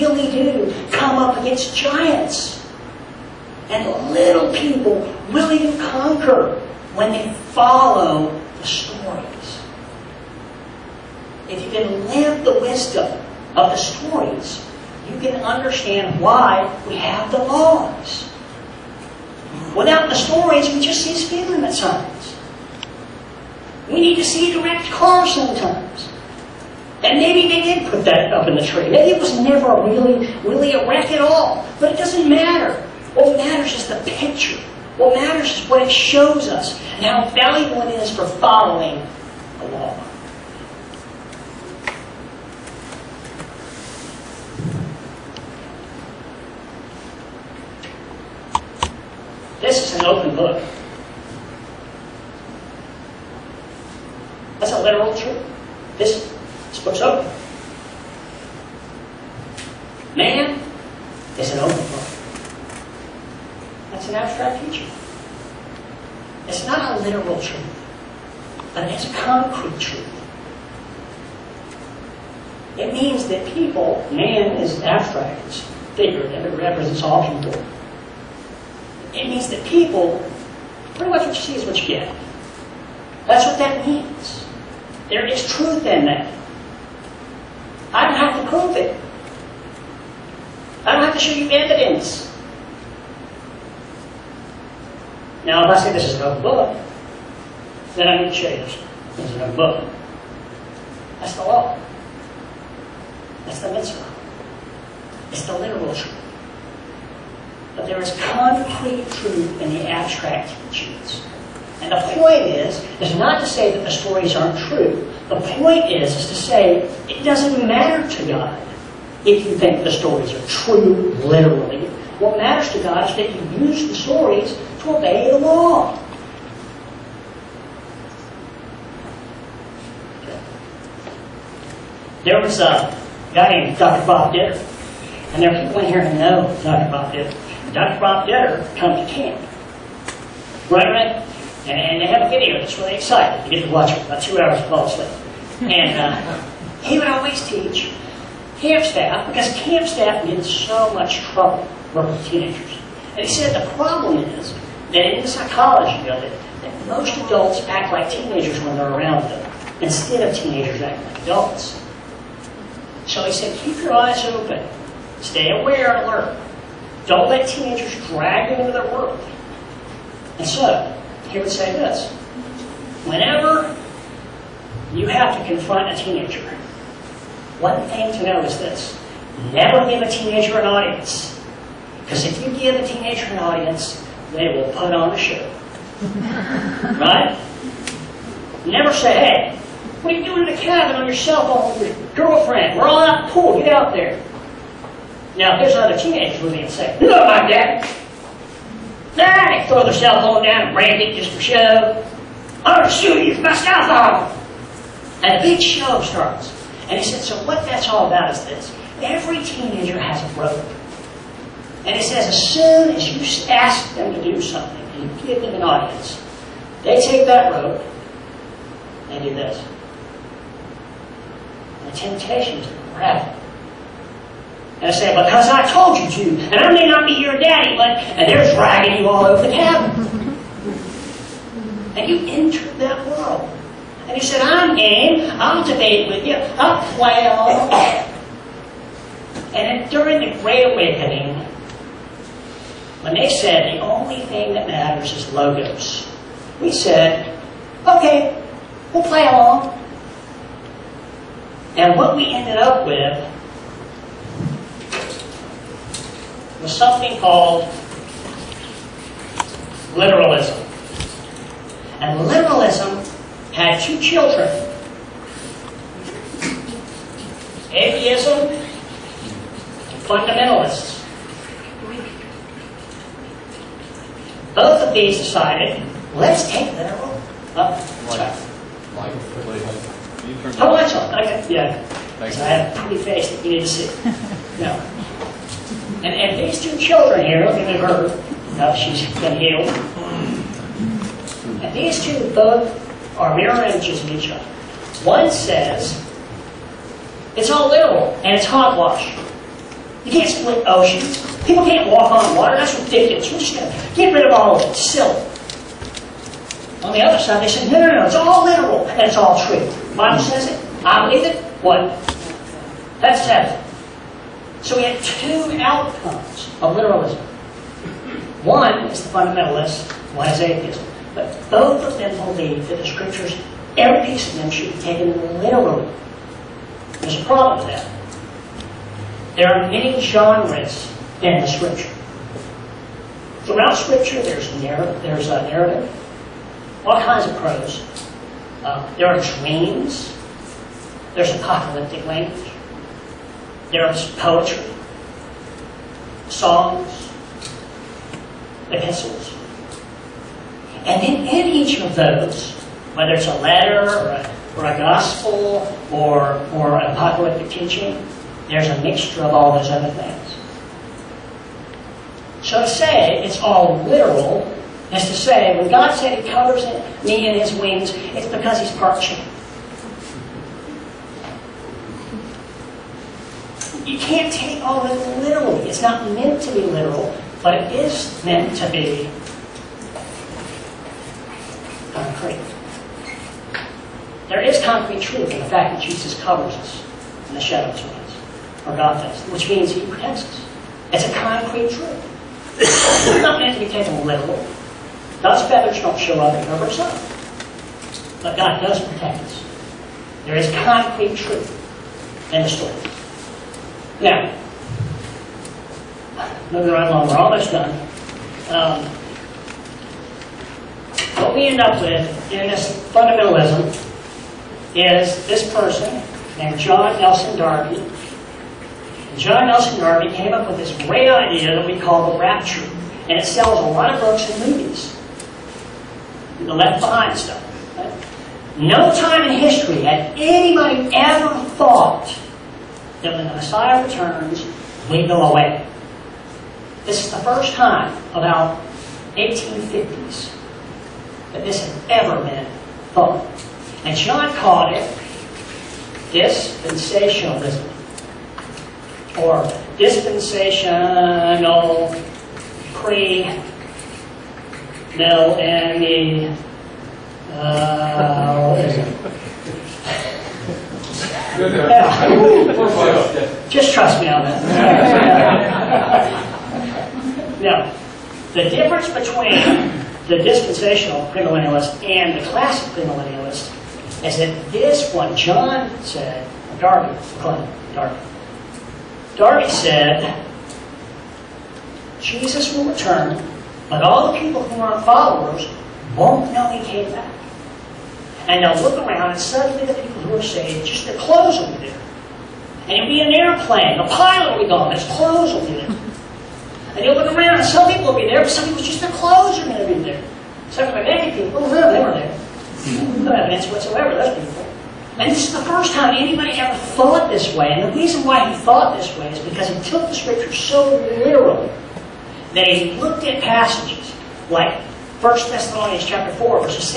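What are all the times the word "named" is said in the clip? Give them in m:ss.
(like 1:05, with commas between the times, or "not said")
2:13, 6:56.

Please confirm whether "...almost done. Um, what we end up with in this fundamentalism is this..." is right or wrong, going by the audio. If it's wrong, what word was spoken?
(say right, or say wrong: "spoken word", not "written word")
right.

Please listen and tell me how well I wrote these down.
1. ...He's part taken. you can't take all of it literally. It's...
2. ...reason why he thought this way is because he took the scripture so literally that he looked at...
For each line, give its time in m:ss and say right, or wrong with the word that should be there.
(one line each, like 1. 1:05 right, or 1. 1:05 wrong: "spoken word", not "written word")
1. 6:08 wrong: "chicken", not "taken"
2. 8:27 right.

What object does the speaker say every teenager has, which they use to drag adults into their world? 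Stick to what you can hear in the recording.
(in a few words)
A rope.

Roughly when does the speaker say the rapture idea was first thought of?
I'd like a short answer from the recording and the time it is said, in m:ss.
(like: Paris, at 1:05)
1850s, at 7:19.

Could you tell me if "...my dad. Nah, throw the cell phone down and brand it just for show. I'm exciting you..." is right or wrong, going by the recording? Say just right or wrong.
wrong.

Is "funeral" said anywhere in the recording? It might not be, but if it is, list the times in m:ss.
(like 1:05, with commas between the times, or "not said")
not said.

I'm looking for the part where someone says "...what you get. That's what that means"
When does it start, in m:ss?
1:21.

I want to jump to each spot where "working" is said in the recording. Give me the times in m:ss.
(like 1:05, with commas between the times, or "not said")
2:31.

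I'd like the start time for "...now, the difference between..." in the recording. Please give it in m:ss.
7:47.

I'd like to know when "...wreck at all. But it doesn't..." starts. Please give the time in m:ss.
0:30.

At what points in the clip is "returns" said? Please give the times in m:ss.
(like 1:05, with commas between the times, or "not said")
7:13, 8:02.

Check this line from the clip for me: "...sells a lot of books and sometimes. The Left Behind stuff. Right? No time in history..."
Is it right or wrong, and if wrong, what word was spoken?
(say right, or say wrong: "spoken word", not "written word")
wrong: "movies", not "sometimes".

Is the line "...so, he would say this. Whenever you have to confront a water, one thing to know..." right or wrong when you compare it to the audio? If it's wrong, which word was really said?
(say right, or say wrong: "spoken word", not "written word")
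wrong: "teenager", not "water".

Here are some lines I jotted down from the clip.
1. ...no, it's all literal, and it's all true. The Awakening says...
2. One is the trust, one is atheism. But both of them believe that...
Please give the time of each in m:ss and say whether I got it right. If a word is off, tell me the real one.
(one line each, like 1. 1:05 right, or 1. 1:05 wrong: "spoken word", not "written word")
1. 5:07 wrong: "Bible", not "Awakening"
2. 5:18 wrong: "fundamentalist", not "trust".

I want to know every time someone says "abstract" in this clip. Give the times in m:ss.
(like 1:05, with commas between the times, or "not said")
1:49.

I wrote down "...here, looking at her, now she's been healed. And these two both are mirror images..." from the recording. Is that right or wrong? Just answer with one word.
right.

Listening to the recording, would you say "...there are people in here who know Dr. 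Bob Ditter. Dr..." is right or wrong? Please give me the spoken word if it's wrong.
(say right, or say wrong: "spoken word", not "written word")
right.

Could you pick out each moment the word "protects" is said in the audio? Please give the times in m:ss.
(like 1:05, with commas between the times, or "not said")
6:29, 6:38.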